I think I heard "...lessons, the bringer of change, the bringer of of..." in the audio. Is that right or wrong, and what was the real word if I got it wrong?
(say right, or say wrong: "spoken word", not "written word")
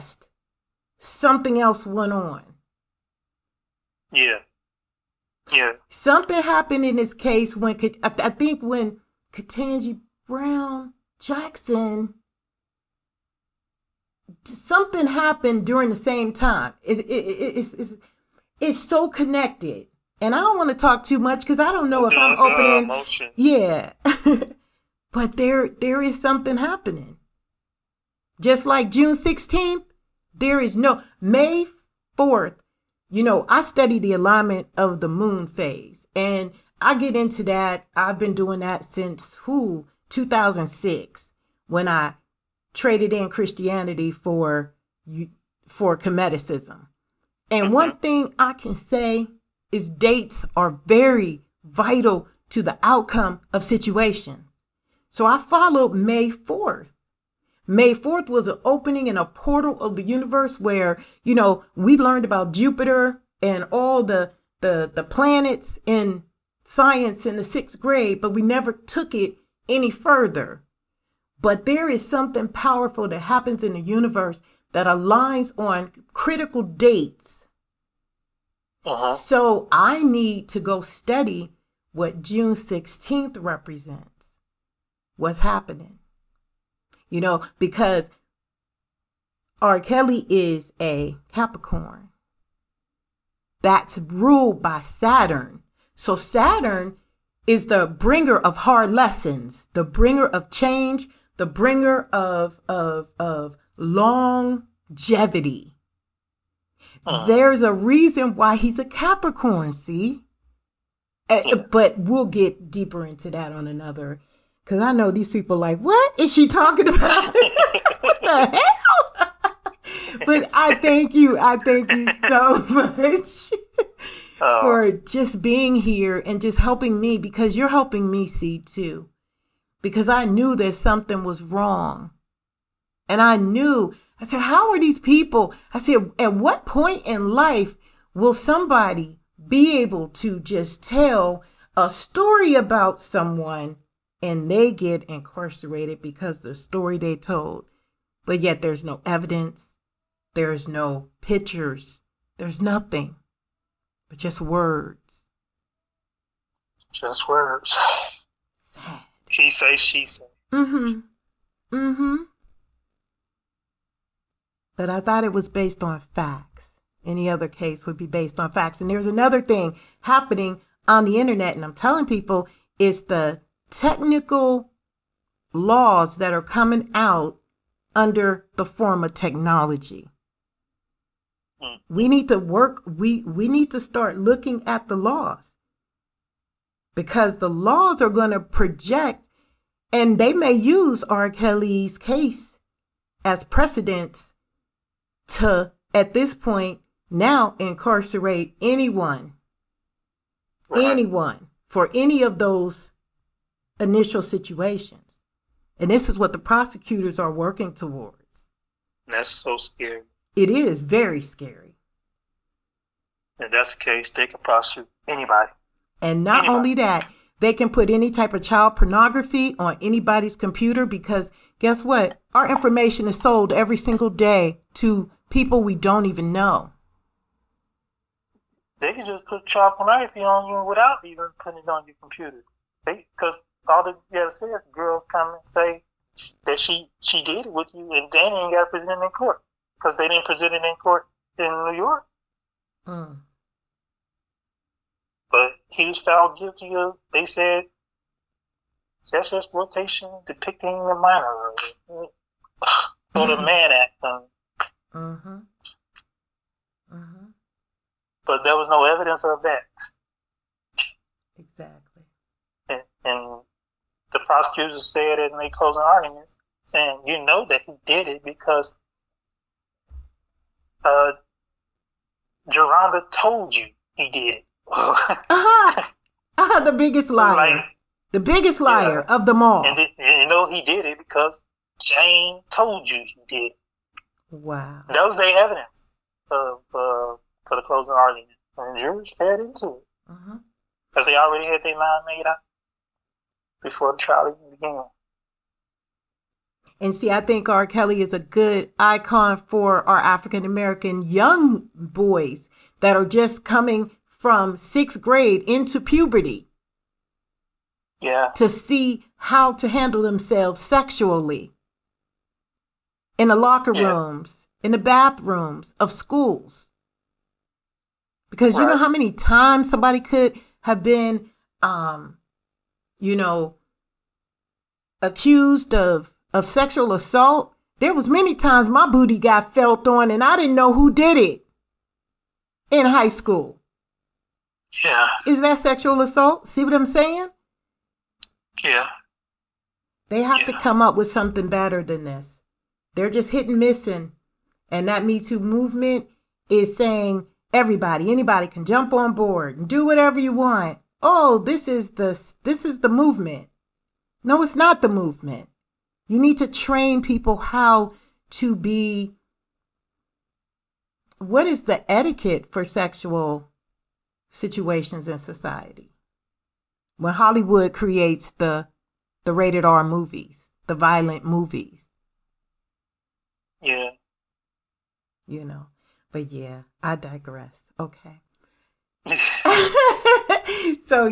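right.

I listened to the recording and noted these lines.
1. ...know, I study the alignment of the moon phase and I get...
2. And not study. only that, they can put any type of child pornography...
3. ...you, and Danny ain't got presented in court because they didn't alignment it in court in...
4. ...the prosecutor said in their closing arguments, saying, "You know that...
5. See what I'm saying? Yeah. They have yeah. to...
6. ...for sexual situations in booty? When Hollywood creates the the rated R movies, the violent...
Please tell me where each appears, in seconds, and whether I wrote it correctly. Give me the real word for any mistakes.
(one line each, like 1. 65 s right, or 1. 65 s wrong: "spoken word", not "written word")
1. 33 s right
2. 216 s wrong: "anybody", not "study"
3. 237 s wrong: "present", not "alignment"
4. 264 s right
5. 336 s right
6. 362 s wrong: "society", not "booty".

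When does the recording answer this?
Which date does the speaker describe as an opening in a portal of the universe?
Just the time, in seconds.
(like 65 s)
57 s.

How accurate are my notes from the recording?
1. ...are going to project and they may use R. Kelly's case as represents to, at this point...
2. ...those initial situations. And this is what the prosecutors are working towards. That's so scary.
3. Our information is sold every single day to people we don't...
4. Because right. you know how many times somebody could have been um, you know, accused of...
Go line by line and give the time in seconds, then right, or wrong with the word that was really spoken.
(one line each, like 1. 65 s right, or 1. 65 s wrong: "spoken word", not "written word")
1. 188 s wrong: "precedents", not "represents"
2. 202 s right
3. 222 s right
4. 318 s right.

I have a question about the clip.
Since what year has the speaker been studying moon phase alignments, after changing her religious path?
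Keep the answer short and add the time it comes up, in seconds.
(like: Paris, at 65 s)
2006, at 40 s.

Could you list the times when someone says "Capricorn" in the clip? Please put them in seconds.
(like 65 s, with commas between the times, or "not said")
91 s, 108 s.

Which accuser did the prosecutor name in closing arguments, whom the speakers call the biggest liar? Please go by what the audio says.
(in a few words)
Jerhonda.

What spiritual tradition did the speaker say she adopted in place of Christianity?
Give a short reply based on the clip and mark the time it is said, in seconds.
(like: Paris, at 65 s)
Kemeticism, at 45 s.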